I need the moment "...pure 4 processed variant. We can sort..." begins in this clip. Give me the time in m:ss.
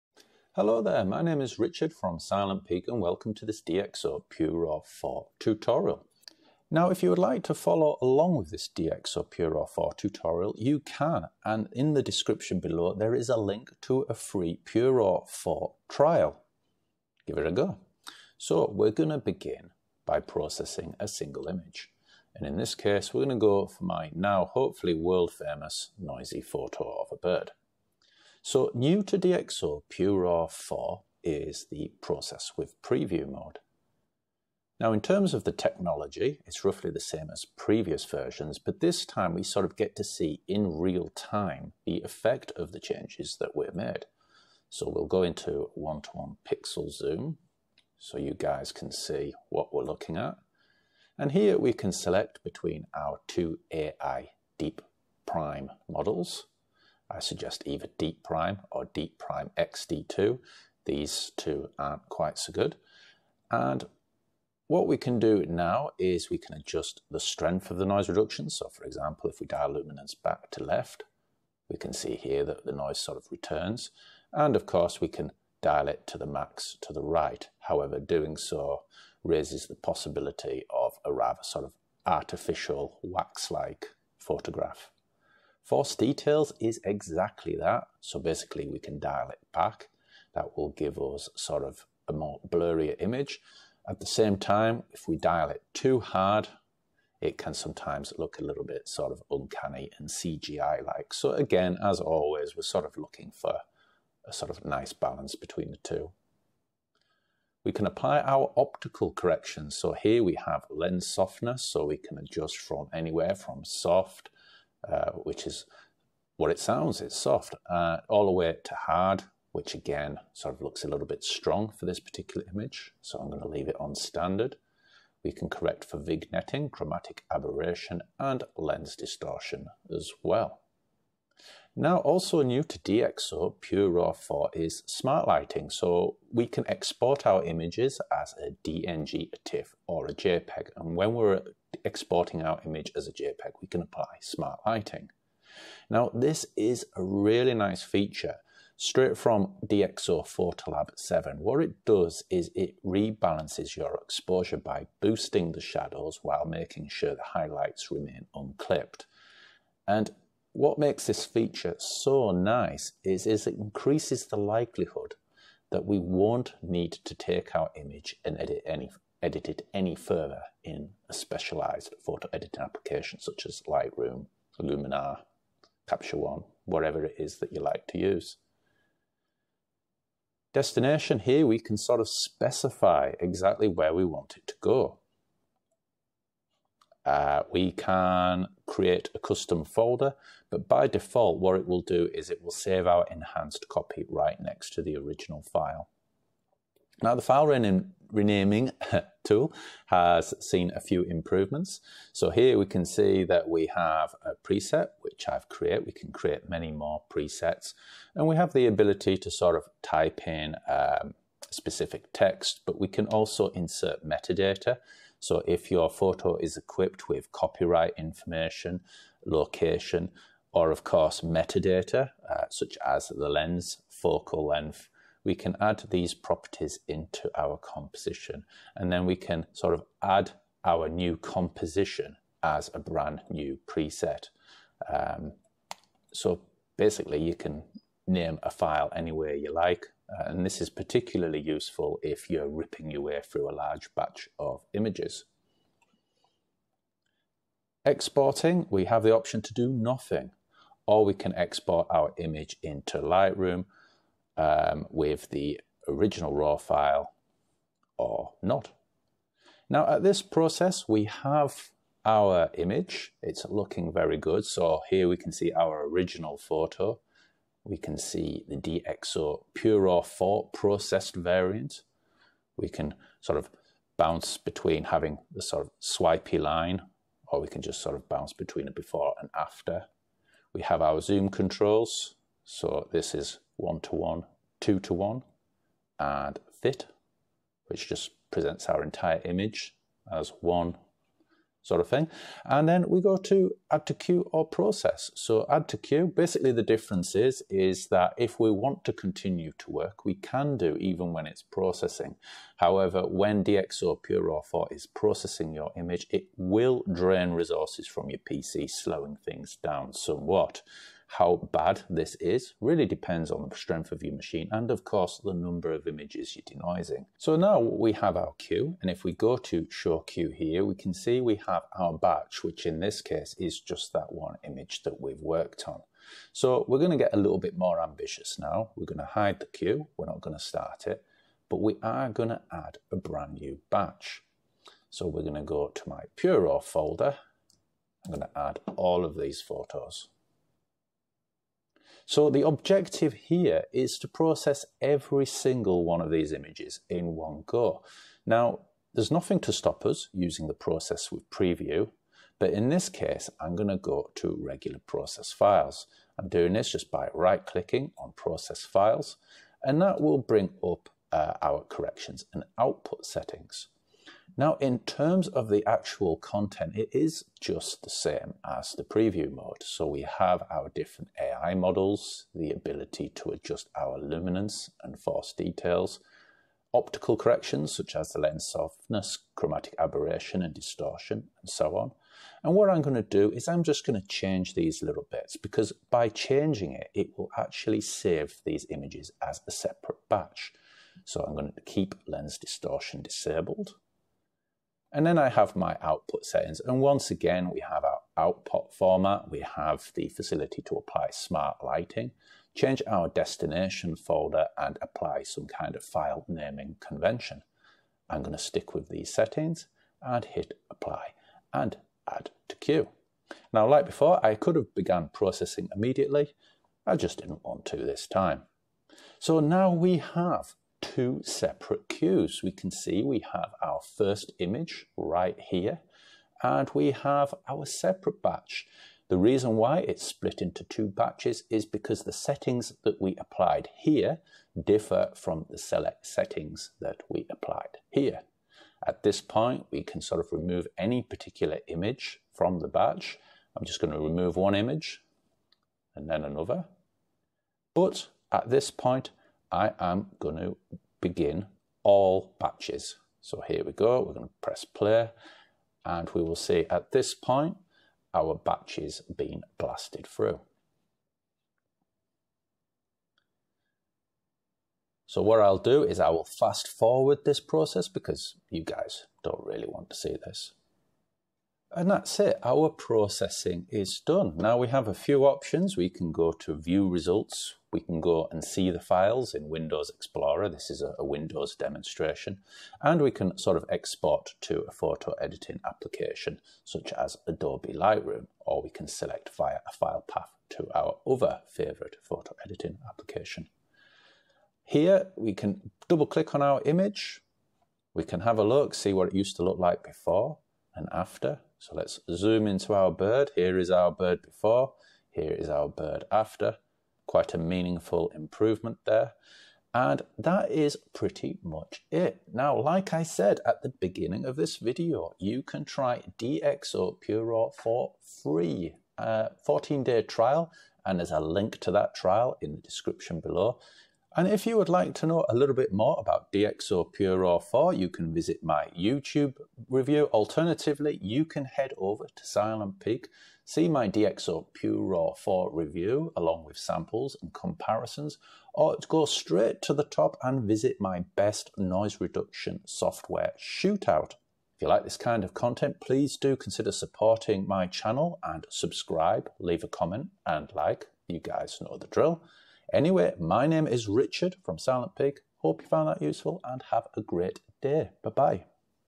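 4:29.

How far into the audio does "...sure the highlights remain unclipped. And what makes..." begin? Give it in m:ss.
2:36.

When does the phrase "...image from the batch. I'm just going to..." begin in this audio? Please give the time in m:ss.
7:21.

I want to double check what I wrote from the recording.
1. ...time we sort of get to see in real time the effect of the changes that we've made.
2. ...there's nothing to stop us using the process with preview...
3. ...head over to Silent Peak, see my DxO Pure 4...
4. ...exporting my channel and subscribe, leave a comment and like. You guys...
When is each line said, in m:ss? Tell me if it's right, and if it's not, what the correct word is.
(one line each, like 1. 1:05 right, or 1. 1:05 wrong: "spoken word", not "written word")
1. 0:39 right
2. 5:48 right
3. 8:51 right
4. 9:06 wrong: "supporting", not "exporting".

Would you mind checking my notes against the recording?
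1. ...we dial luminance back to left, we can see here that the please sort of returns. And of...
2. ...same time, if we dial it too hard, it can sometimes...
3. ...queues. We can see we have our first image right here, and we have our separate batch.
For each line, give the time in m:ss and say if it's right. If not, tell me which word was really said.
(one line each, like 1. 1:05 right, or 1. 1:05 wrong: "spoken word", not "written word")
1. 1:09 wrong: "noise", not "please"
2. 1:34 right
3. 7:01 right.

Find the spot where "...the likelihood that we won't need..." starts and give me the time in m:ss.
2:44.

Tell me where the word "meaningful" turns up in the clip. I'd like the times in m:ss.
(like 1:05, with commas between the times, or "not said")
8:27.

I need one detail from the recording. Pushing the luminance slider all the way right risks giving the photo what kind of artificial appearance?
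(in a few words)
Wax-like.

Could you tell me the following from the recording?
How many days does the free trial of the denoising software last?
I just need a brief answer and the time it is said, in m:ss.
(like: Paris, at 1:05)
14, at 8:39.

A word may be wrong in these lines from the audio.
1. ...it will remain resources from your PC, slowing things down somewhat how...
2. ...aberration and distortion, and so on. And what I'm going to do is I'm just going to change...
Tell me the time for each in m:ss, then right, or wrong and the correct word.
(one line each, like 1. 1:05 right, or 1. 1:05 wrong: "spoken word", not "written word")
1. 5:06 wrong: "drain", not "remain"
2. 6:19 right.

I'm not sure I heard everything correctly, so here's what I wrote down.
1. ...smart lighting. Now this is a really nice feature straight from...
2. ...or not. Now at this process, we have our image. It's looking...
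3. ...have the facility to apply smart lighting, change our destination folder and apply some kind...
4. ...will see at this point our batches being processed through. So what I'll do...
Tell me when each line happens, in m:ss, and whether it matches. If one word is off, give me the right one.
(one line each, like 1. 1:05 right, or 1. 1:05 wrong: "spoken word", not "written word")
1. 2:24 right
2. 4:17 right
3. 6:39 right
4. 7:36 wrong: "blasted", not "processed".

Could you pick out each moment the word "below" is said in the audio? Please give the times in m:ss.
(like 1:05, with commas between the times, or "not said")
0:12, 8:43.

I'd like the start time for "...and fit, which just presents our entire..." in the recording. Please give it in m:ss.
4:45.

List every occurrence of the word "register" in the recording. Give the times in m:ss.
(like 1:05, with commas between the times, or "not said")
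not said.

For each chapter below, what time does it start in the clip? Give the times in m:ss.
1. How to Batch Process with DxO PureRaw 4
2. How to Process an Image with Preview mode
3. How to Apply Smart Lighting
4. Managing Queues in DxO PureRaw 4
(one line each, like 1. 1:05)
1. 5:17
2. 0:18
3. 2:22
4. 6:53.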